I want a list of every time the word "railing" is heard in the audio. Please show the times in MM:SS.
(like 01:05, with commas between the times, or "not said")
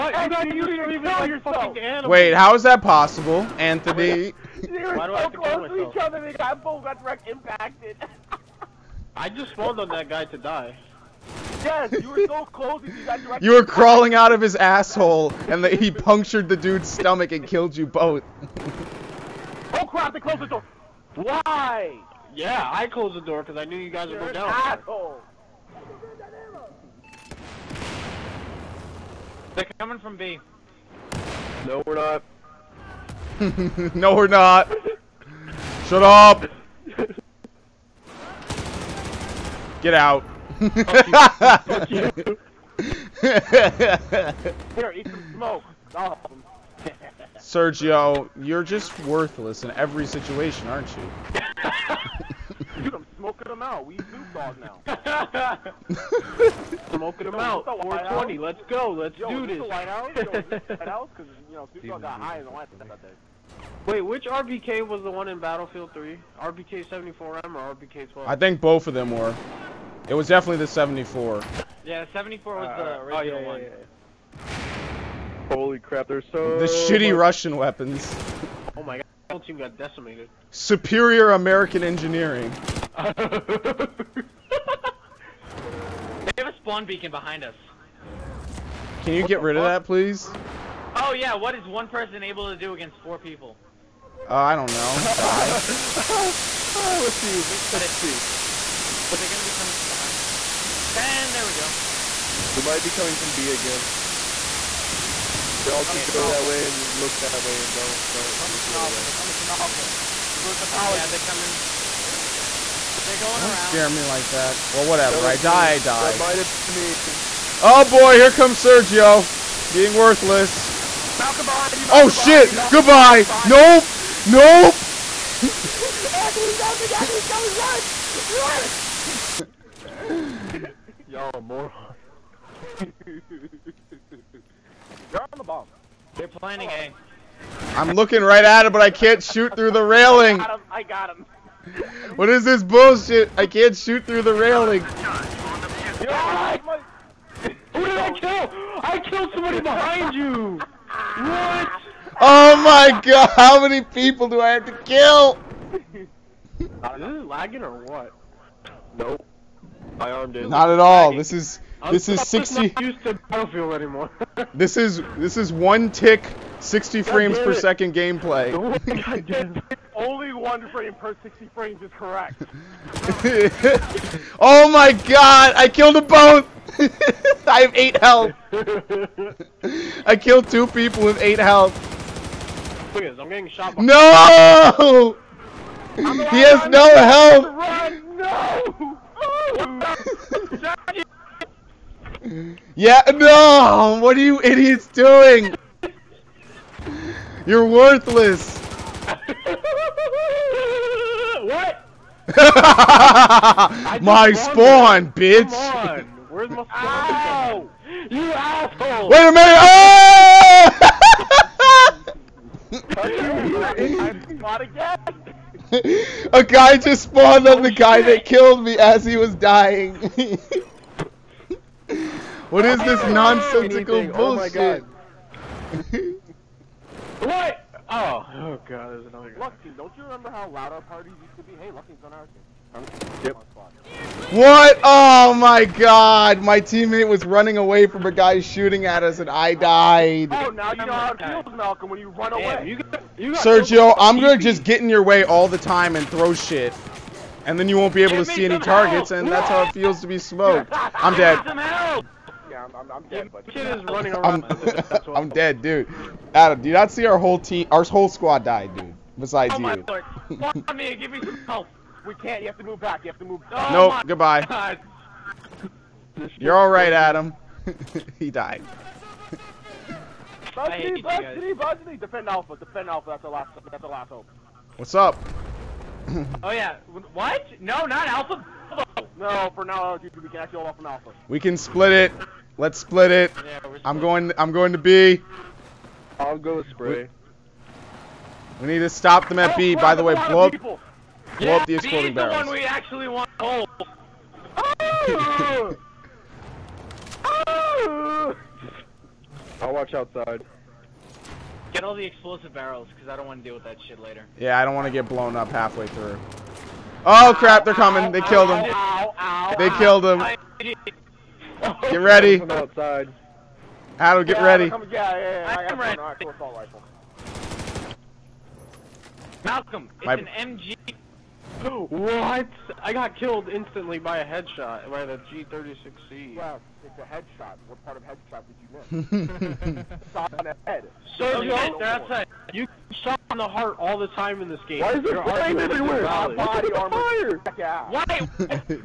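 02:19, 02:24.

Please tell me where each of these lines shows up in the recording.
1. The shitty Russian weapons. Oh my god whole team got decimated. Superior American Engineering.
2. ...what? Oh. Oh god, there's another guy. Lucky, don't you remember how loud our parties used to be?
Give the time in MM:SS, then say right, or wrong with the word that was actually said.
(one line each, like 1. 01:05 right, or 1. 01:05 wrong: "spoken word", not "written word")
1. 01:16 right
2. 03:47 right.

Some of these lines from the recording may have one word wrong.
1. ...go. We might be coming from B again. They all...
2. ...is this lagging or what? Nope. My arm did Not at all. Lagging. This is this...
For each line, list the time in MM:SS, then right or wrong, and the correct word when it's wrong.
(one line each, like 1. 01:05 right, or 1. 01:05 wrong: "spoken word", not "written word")
1. 01:41 right
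2. 02:35 right.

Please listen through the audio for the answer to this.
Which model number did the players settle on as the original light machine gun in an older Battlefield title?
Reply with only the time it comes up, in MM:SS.
01:10.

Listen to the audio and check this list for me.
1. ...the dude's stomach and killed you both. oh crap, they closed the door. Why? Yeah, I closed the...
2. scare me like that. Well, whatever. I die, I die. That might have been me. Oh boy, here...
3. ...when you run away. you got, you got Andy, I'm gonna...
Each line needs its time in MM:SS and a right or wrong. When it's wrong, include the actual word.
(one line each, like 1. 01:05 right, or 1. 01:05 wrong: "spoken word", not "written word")
1. 00:16 right
2. 01:53 right
3. 04:01 wrong: "Sergio", not "Andy".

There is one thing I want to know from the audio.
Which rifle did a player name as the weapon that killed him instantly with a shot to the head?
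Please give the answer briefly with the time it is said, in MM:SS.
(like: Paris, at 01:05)
G36C, at 05:24.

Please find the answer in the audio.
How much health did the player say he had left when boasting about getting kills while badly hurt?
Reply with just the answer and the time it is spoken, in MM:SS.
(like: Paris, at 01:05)
8, at 02:57.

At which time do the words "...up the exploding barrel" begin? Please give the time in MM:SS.
04:51.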